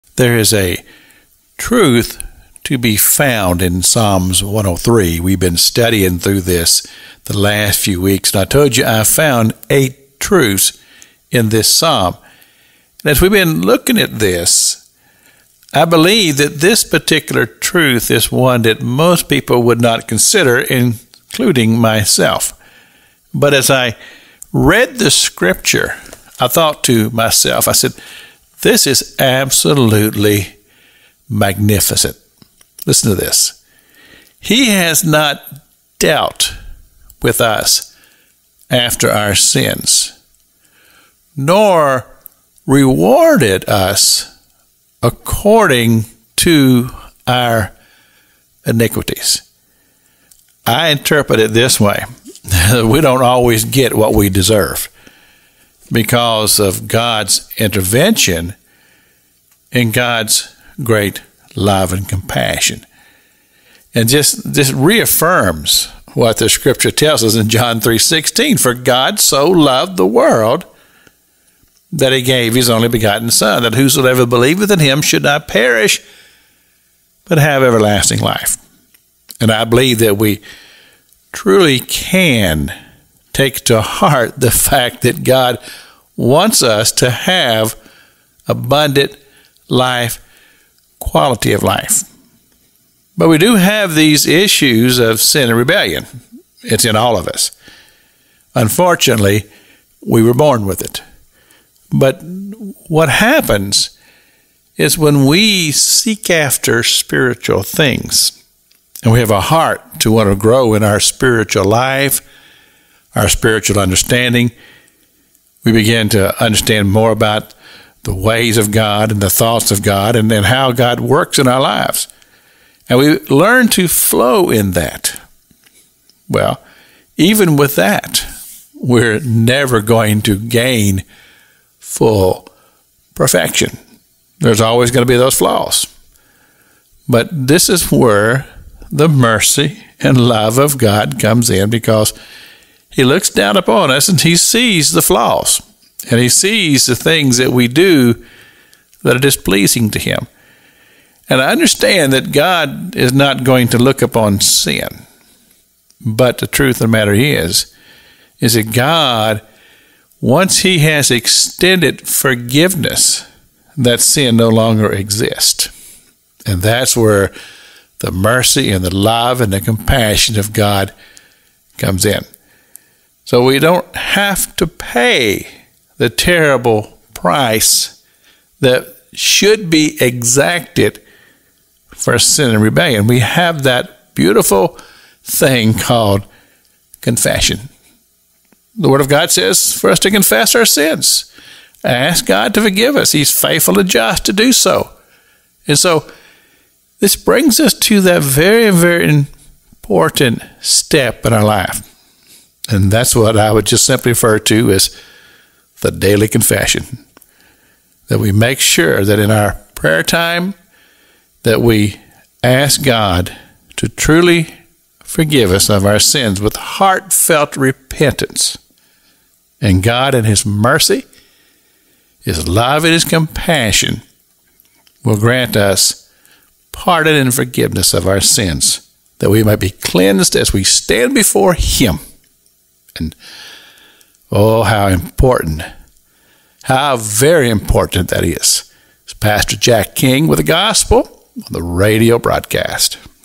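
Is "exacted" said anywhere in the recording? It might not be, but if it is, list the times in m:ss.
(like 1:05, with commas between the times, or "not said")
3:00.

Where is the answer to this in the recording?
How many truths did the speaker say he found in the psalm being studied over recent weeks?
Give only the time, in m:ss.
0:09.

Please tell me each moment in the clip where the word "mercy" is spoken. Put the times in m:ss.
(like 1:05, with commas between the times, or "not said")
2:19, 2:48, 3:40.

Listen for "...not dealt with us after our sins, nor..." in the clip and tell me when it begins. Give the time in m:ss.
0:35.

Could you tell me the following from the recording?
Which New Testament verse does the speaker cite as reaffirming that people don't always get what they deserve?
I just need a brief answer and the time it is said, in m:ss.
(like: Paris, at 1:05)
John 3:16, at 1:07.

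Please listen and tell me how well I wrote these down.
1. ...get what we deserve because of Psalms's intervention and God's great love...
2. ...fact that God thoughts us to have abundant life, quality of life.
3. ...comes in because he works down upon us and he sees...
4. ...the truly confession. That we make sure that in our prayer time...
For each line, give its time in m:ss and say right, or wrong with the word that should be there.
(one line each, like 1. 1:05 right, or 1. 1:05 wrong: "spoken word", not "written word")
1. 0:53 wrong: "God", not "Psalms"
2. 1:24 wrong: "wants", not "thoughts"
3. 2:21 wrong: "looks", not "works"
4. 3:25 wrong: "daily", not "truly".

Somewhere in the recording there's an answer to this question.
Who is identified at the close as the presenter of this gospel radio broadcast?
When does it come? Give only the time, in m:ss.
3:59.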